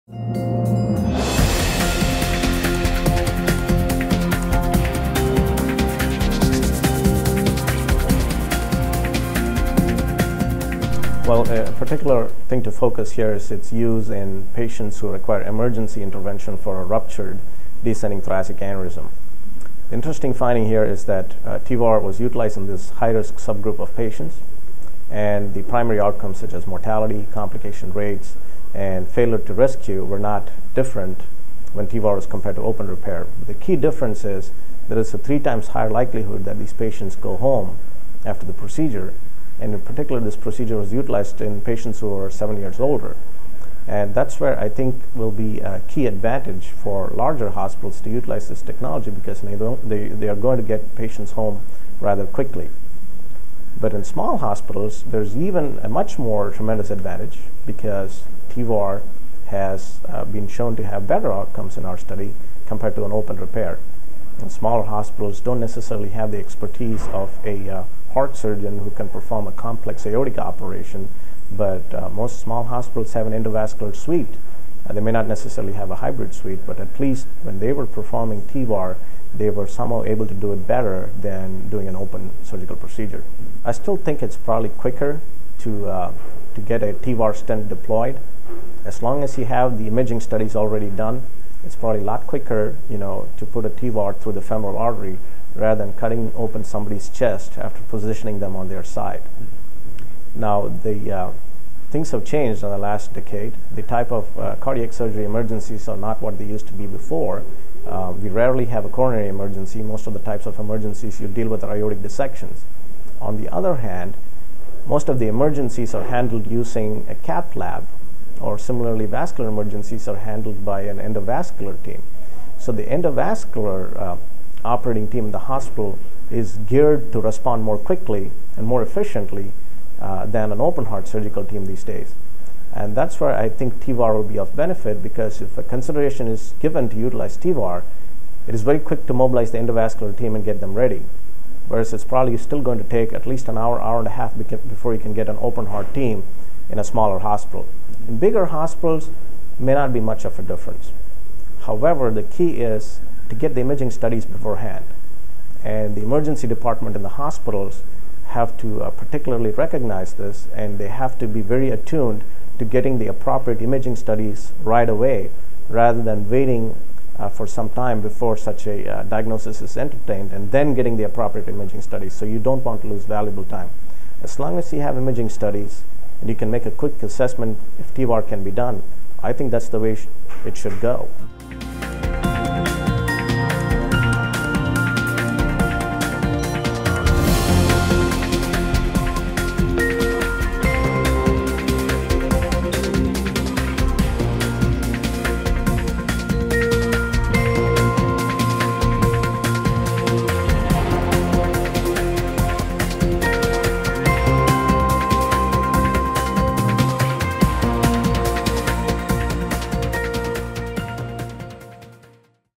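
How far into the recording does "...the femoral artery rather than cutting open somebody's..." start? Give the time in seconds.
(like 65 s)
94 s.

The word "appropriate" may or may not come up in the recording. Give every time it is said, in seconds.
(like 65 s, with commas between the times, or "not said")
163 s, 171 s.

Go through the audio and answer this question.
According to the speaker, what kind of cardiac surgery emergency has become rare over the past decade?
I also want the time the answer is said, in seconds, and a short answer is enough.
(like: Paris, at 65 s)
coronary emergency, at 108 s.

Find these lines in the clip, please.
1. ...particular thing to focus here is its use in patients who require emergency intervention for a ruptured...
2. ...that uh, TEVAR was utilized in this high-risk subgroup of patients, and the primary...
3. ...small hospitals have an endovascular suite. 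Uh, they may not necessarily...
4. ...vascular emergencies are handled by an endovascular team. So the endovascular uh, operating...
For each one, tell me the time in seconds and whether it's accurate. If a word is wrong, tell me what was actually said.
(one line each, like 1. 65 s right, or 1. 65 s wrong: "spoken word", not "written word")
1. 11 s right
2. 21 s right
3. 72 s right
4. 119 s right.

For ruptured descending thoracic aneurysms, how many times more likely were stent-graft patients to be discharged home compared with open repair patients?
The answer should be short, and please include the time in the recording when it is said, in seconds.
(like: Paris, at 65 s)
3 times, at 35 s.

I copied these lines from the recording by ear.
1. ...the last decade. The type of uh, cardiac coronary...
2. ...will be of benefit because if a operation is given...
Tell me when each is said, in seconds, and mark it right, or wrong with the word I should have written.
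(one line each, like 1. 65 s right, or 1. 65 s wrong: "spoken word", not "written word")
1. 102 s wrong: "surgery", not "coronary"
2. 134 s wrong: "consideration", not "operation".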